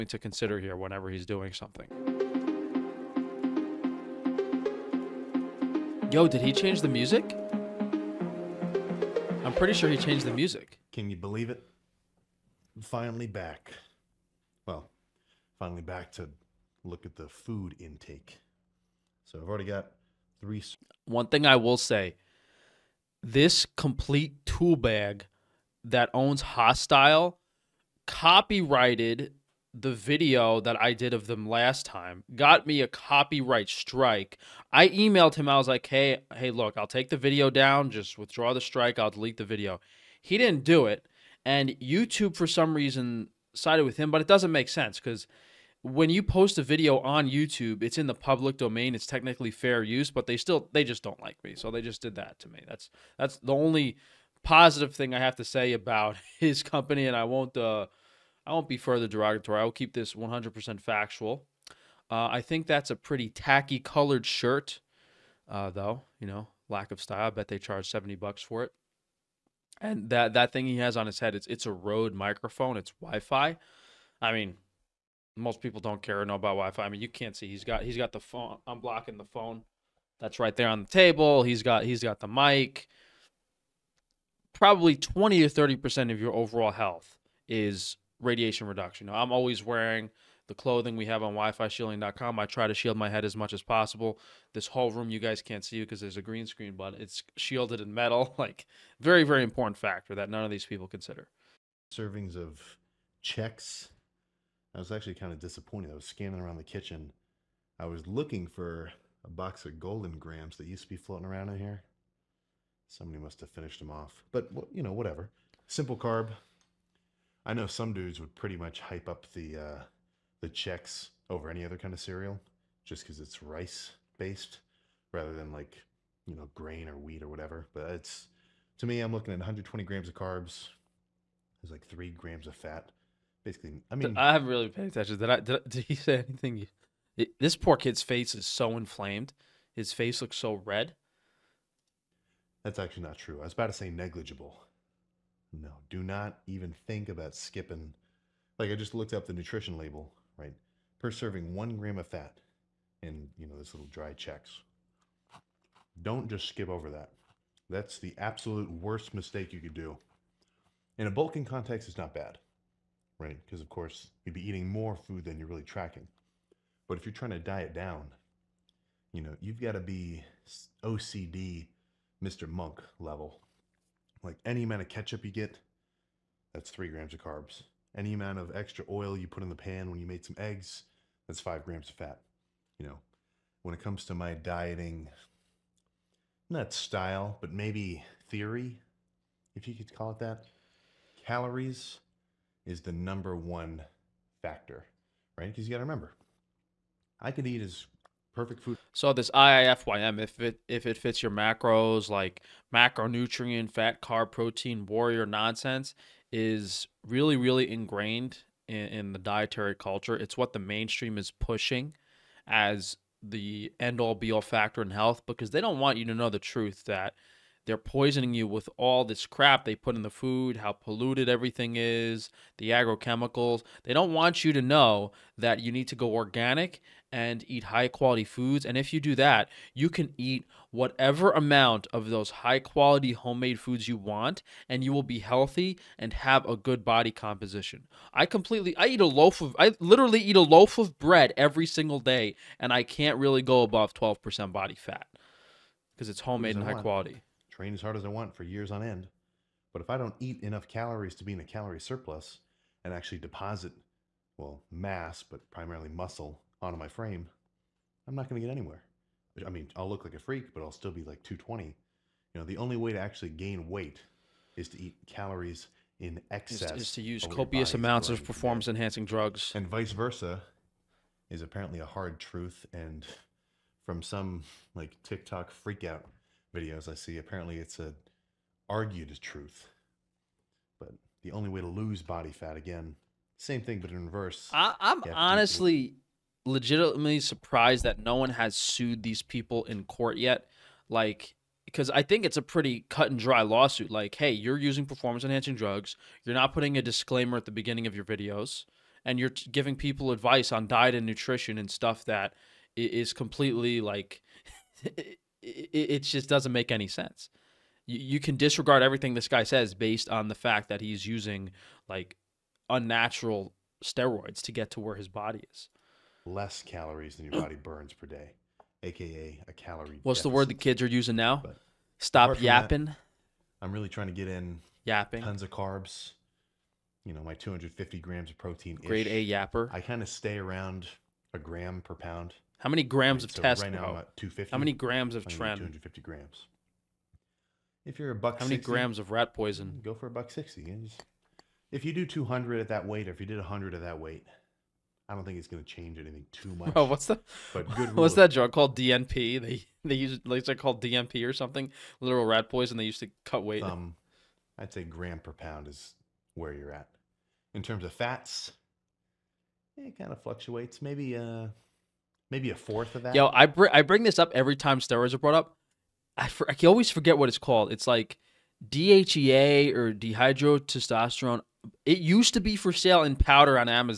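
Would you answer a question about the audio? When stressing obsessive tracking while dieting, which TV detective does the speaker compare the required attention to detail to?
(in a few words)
Mr. Monk.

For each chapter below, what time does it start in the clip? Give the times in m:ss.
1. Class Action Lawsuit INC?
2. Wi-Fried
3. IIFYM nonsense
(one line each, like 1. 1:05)
1. 4:43
2. 1:08
3. 3:17.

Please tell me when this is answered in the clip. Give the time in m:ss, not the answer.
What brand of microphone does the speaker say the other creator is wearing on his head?
1:11.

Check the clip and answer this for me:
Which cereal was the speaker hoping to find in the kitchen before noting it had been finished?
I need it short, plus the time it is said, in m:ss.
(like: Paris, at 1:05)
Golden Grahams, at 1:49.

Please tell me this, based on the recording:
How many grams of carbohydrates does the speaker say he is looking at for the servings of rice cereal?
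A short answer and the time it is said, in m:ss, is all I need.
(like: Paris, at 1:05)
120 grams, at 2:09.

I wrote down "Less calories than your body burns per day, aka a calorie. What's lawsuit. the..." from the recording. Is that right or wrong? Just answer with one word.
wrong.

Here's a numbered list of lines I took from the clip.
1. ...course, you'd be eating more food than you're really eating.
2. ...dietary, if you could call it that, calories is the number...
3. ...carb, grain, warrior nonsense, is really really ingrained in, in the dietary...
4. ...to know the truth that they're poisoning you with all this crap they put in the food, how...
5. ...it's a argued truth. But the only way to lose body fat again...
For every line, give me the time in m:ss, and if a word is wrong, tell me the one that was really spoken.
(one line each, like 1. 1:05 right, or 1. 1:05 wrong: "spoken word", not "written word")
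1. 2:43 wrong: "tracking", not "eating"
2. 3:08 wrong: "theory", not "dietary"
3. 3:24 wrong: "protein", not "grain"
4. 3:36 right
5. 4:37 right.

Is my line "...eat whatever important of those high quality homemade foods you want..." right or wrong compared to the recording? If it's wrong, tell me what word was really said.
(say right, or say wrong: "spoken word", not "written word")
wrong: "amount", not "important".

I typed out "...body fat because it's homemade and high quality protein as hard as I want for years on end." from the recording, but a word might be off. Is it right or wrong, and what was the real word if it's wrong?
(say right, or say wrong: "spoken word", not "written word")
wrong: "train", not "protein".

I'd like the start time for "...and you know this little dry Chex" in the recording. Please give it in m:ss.
2:33.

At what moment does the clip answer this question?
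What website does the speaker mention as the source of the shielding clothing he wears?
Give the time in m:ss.
1:31.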